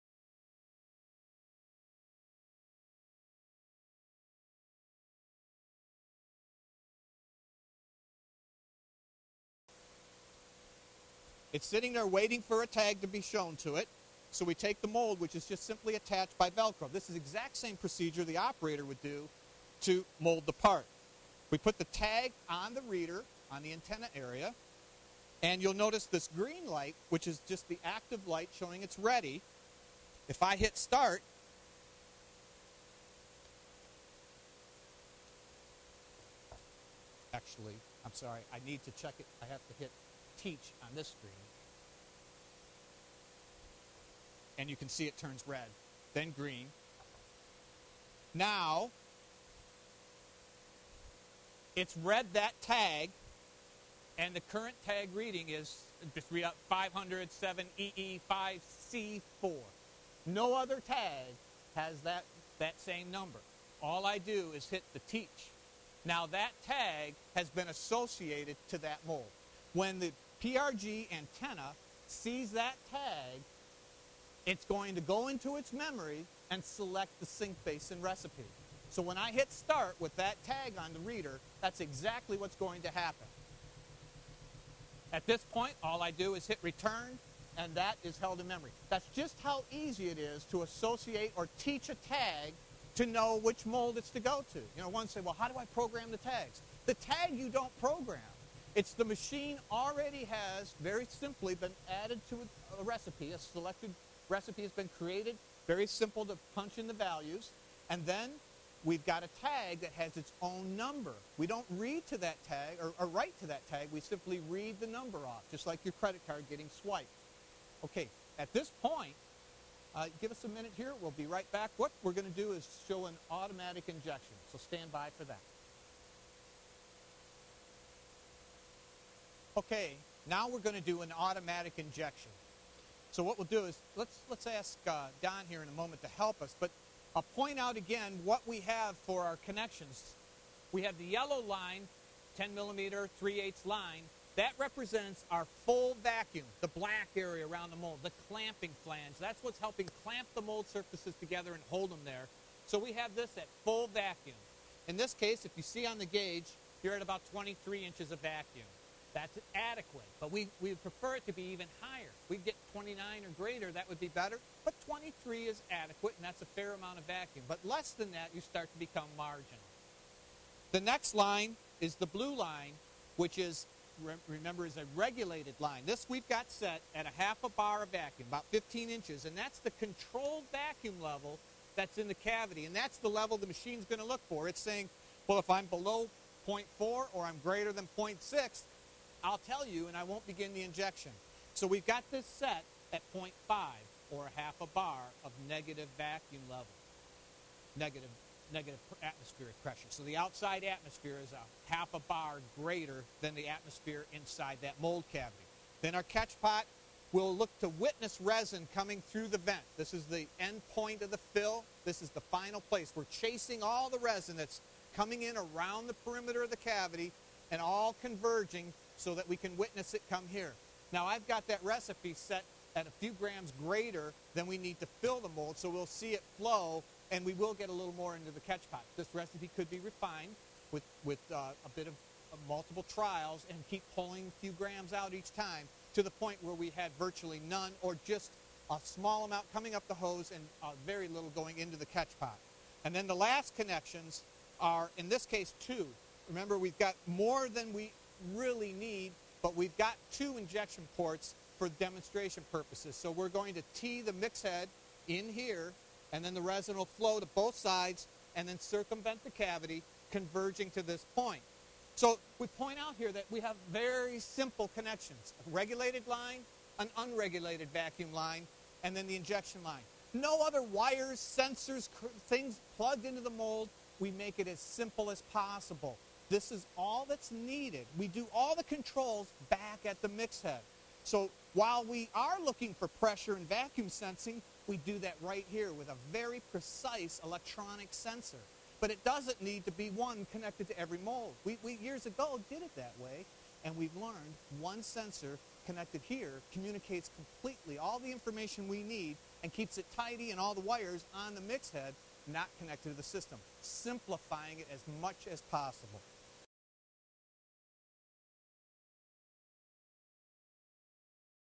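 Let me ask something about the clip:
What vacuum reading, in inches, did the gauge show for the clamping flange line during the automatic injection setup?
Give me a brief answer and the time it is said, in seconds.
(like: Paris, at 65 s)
23 inches, at 157 s.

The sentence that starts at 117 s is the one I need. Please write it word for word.
Okay, at this point, uh, give us a minute here.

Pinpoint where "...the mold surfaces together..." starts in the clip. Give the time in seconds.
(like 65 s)
150 s.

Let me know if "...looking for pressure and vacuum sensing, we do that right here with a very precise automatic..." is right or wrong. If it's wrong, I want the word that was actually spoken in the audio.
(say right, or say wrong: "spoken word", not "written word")
wrong: "electronic", not "automatic".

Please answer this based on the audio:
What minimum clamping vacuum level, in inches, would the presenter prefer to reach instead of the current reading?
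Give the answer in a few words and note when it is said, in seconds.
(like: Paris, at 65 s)
29, at 162 s.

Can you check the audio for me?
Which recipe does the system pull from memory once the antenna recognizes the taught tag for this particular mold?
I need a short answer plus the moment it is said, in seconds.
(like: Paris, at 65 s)
sink basin, at 77 s.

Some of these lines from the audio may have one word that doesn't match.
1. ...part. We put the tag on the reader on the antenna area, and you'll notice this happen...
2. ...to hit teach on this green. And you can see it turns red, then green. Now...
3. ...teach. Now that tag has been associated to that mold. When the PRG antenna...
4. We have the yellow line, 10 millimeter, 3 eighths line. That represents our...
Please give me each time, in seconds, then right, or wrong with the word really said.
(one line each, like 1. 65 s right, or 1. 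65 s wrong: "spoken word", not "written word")
1. 20 s wrong: "green", not "happen"
2. 39 s wrong: "screen", not "green"
3. 65 s right
4. 140 s right.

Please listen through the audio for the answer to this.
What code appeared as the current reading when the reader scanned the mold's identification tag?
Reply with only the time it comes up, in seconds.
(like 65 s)
56 s.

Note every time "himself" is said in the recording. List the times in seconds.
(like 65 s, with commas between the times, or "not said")
not said.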